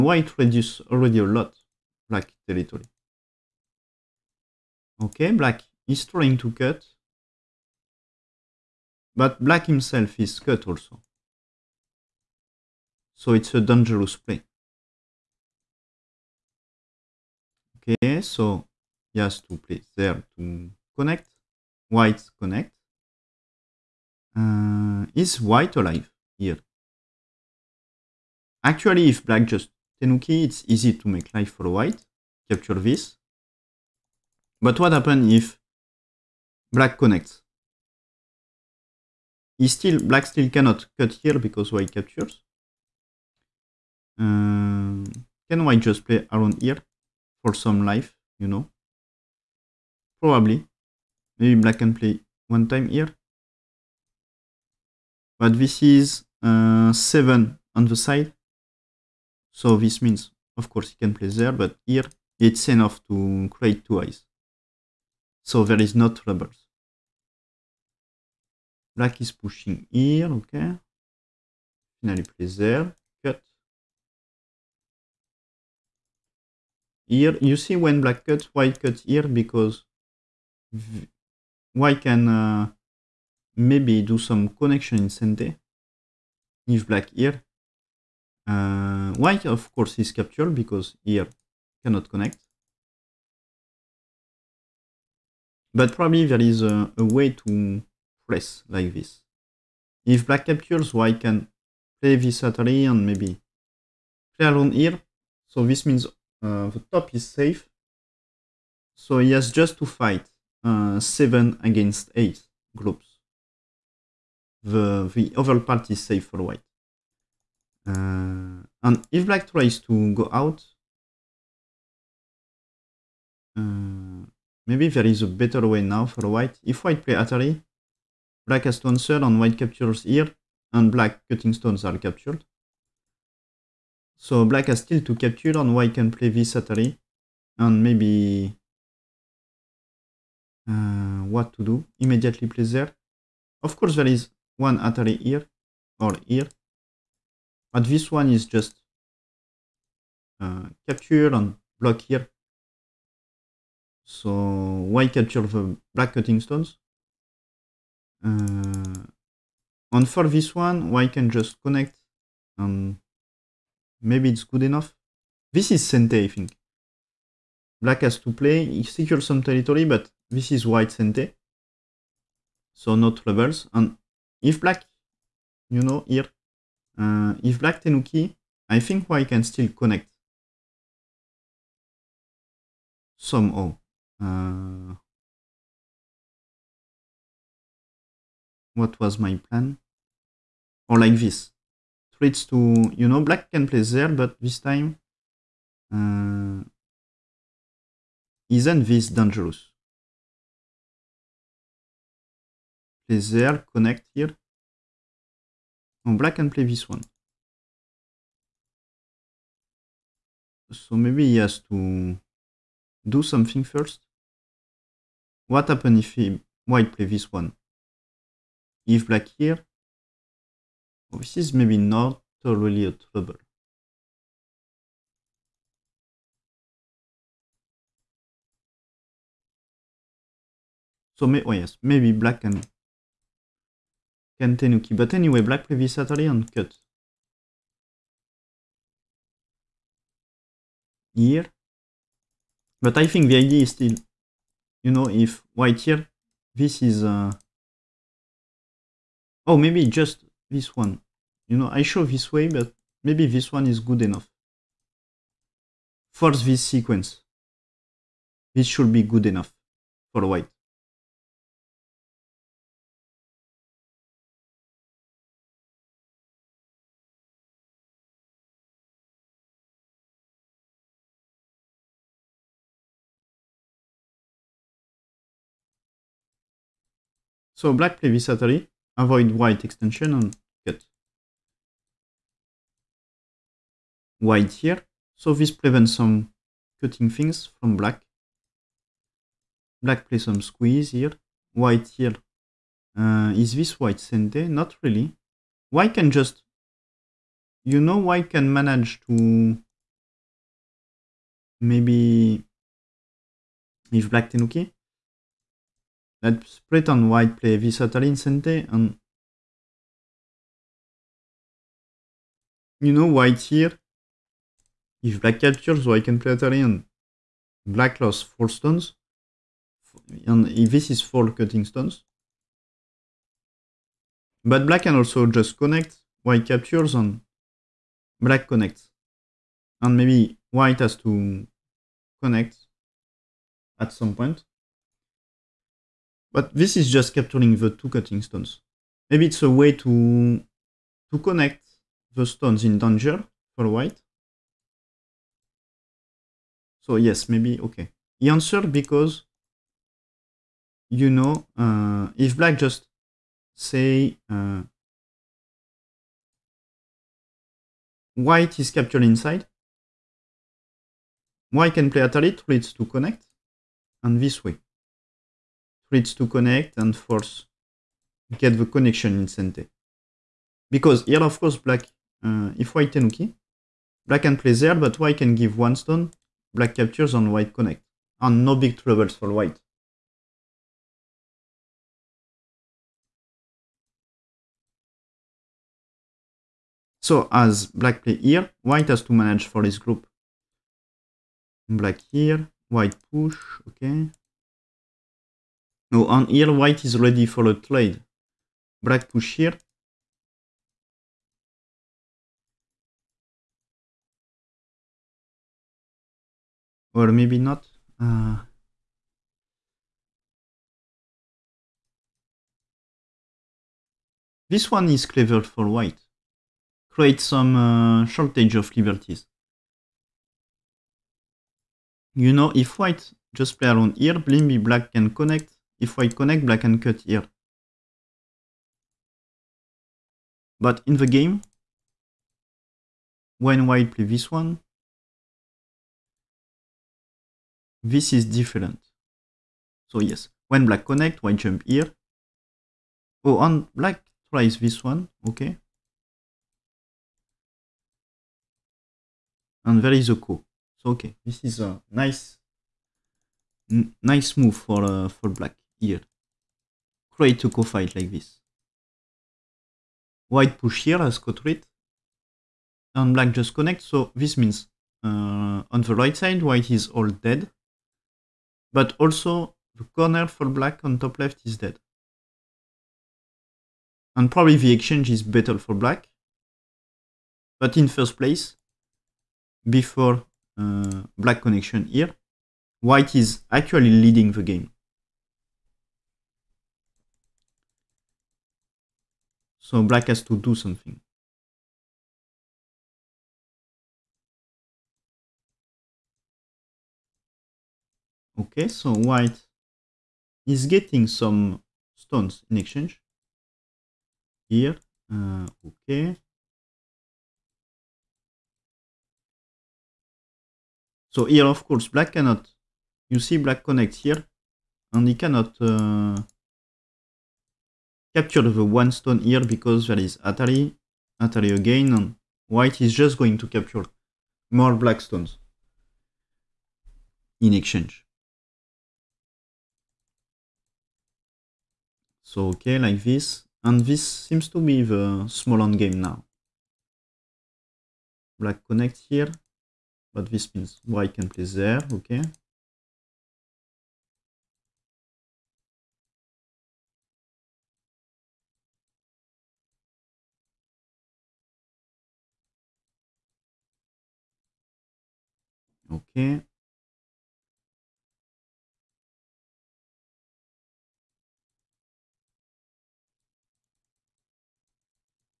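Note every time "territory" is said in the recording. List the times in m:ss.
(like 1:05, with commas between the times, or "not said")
0:02, 2:49.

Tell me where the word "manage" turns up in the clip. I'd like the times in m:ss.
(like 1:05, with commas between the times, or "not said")
4:58, 6:29.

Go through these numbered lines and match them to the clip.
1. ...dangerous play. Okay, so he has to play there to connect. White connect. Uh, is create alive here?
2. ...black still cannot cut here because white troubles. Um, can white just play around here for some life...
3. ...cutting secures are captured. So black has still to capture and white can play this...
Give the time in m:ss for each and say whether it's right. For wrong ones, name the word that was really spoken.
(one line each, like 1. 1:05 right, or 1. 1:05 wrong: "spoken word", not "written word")
1. 0:13 wrong: "white", not "create"
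2. 0:40 wrong: "captures", not "troubles"
3. 2:11 wrong: "stones", not "secures".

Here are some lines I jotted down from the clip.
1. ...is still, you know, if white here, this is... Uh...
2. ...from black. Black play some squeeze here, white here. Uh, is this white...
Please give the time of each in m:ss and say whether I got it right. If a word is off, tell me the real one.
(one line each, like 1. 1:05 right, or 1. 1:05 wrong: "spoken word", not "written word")
1. 4:03 right
2. 4:47 right.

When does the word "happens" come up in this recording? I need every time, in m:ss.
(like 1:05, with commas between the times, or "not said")
0:34, 3:35.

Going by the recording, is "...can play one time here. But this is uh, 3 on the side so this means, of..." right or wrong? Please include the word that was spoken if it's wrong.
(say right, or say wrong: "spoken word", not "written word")
wrong: "7", not "3".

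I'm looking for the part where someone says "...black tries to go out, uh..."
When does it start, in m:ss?
1:59.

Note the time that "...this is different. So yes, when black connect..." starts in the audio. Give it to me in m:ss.
7:17.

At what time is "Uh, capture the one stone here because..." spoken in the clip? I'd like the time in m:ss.
8:35.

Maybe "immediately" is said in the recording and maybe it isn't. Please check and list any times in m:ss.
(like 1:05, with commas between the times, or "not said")
2:21.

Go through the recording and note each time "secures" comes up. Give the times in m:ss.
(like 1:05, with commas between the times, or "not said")
2:48.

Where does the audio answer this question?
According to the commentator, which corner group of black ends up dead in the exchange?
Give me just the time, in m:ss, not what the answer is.
7:51.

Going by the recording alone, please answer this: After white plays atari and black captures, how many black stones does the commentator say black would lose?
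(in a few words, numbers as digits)
4.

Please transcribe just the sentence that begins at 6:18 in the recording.
And no big troubles for white.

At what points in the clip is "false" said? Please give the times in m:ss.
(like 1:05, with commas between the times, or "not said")
6:06.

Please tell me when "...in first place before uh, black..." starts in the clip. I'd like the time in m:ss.
7:57.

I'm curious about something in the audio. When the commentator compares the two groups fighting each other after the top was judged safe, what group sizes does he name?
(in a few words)
7 against 8.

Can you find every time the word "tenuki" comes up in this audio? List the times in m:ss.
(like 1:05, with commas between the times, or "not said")
0:30, 2:57, 5:04.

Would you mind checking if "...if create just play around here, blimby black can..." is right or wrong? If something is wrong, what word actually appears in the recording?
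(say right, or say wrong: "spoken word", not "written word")
wrong: "white", not "create".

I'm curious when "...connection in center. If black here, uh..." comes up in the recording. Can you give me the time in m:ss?
1:24.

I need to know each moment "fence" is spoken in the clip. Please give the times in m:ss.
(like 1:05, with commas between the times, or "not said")
not said.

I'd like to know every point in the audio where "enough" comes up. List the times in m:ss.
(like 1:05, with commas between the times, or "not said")
1:02, 2:44, 4:14, 4:19.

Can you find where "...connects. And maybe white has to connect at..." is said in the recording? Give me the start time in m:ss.
5:28.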